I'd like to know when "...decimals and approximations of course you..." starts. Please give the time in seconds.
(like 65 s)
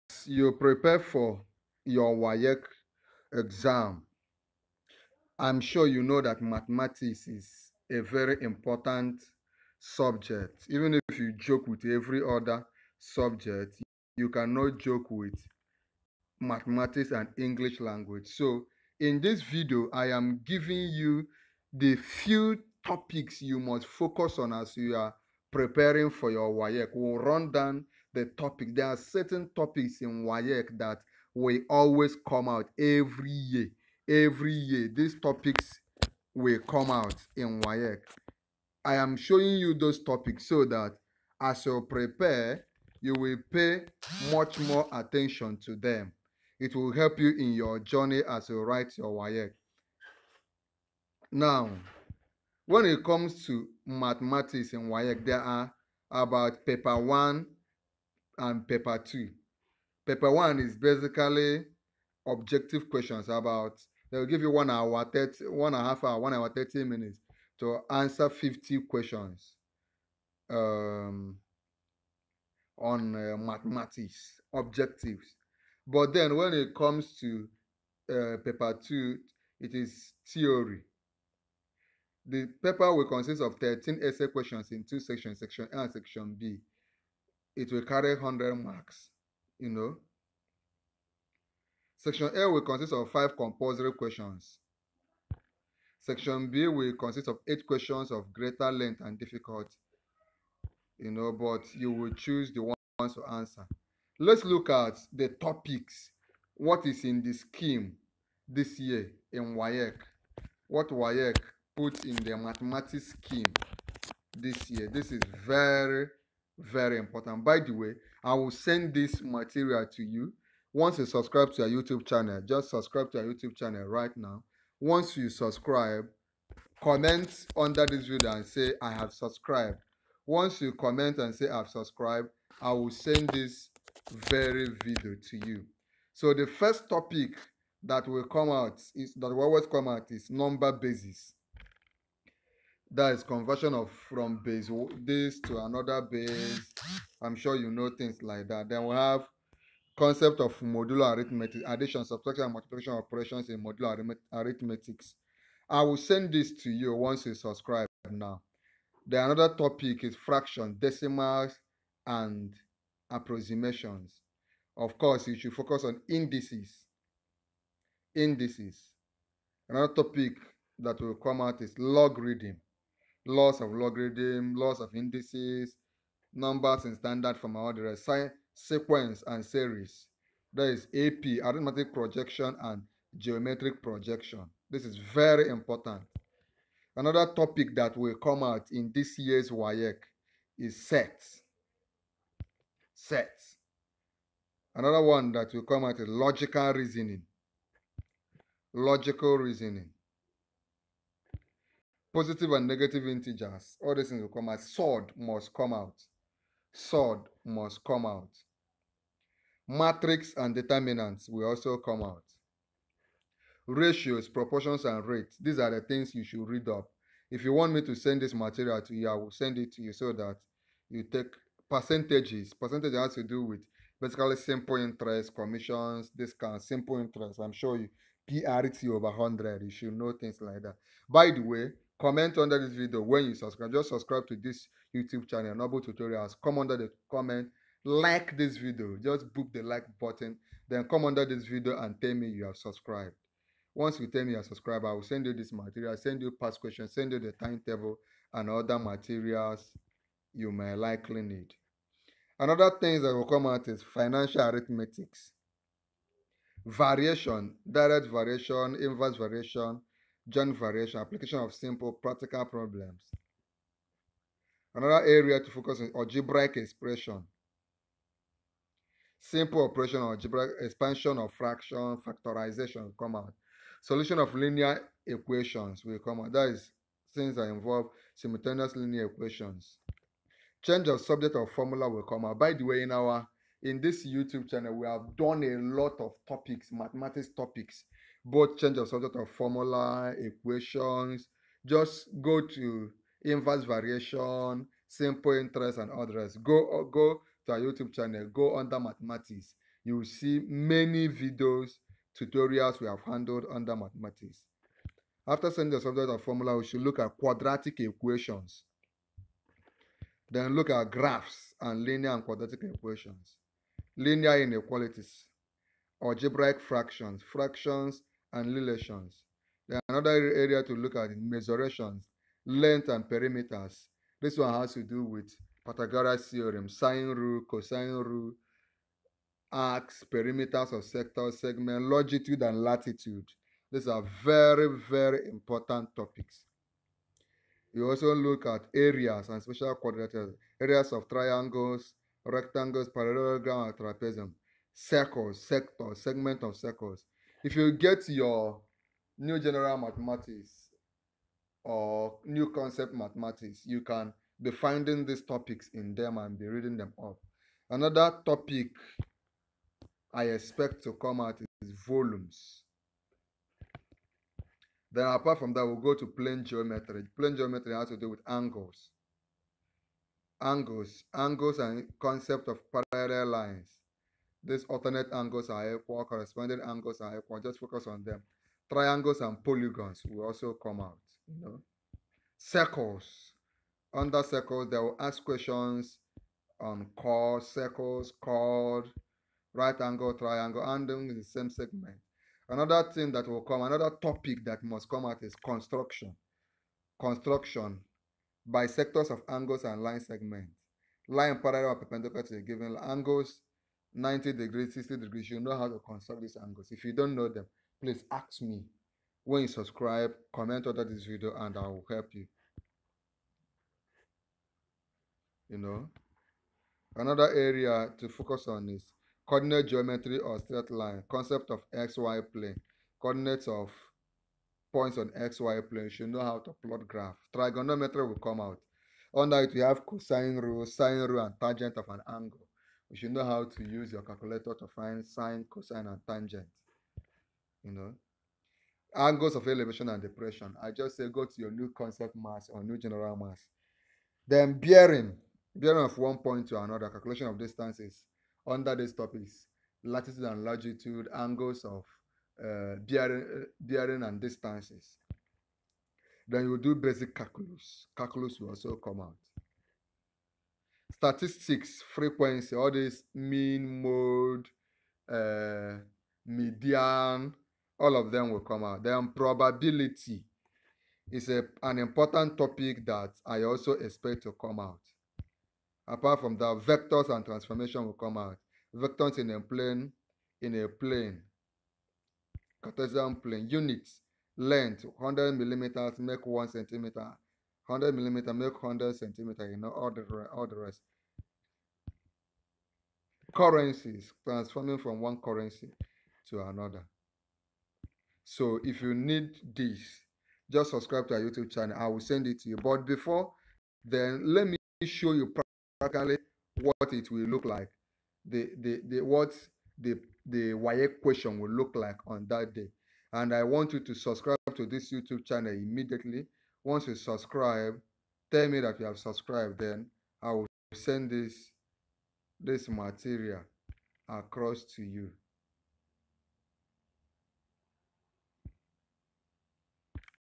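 160 s.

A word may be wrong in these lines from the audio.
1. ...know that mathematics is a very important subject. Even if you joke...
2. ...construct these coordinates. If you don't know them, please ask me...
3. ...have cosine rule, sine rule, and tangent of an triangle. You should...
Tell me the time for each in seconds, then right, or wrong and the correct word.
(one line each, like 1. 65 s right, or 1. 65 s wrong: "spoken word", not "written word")
1. 6 s right
2. 405 s wrong: "angles", not "coordinates"
3. 429 s wrong: "angle", not "triangle".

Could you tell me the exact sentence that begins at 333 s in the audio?
These are very, very important topics.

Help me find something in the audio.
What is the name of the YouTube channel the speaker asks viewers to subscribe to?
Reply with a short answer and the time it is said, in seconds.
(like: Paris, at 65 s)
Noble Tutorials, at 235 s.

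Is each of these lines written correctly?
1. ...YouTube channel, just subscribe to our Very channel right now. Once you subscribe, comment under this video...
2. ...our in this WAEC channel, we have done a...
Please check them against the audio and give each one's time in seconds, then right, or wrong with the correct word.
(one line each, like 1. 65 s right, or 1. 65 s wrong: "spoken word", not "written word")
1. 121 s wrong: "YouTube", not "Very"
2. 282 s wrong: "YouTube", not "WAEC".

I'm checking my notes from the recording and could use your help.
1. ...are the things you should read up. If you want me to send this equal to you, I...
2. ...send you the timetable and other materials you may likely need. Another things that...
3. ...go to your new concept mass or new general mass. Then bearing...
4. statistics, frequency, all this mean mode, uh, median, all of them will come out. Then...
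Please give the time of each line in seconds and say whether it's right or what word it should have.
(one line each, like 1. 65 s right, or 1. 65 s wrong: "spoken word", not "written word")
1. 215 s wrong: "material", not "equal"
2. 246 s right
3. 441 s right
4. 460 s right.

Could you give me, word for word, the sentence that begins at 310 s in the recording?
Then look at graphs and linear and quadratic equations.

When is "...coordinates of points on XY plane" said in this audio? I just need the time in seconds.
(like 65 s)
423 s.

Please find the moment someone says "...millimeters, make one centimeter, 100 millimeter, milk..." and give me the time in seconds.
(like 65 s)
485 s.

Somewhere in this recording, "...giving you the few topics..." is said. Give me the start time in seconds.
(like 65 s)
20 s.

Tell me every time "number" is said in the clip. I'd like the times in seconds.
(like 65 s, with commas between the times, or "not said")
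140 s, 176 s.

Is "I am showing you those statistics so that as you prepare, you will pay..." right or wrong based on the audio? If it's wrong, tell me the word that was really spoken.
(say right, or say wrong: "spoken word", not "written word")
wrong: "topics", not "statistics".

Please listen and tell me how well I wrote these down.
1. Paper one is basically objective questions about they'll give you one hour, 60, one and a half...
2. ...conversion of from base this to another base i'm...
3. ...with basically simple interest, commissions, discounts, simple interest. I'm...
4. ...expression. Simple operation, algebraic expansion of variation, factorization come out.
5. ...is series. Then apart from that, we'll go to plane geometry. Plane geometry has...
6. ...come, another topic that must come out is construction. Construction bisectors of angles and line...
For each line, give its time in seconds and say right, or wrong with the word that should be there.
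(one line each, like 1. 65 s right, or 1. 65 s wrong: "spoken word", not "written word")
1. 60 s wrong: "30", not "60"
2. 143 s right
3. 223 s right
4. 266 s wrong: "fraction", not "variation"
5. 361 s wrong: "volumes", not "series"
6. 393 s right.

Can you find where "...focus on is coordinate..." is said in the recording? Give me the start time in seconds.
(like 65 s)
418 s.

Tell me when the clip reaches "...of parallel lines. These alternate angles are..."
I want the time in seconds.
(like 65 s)
372 s.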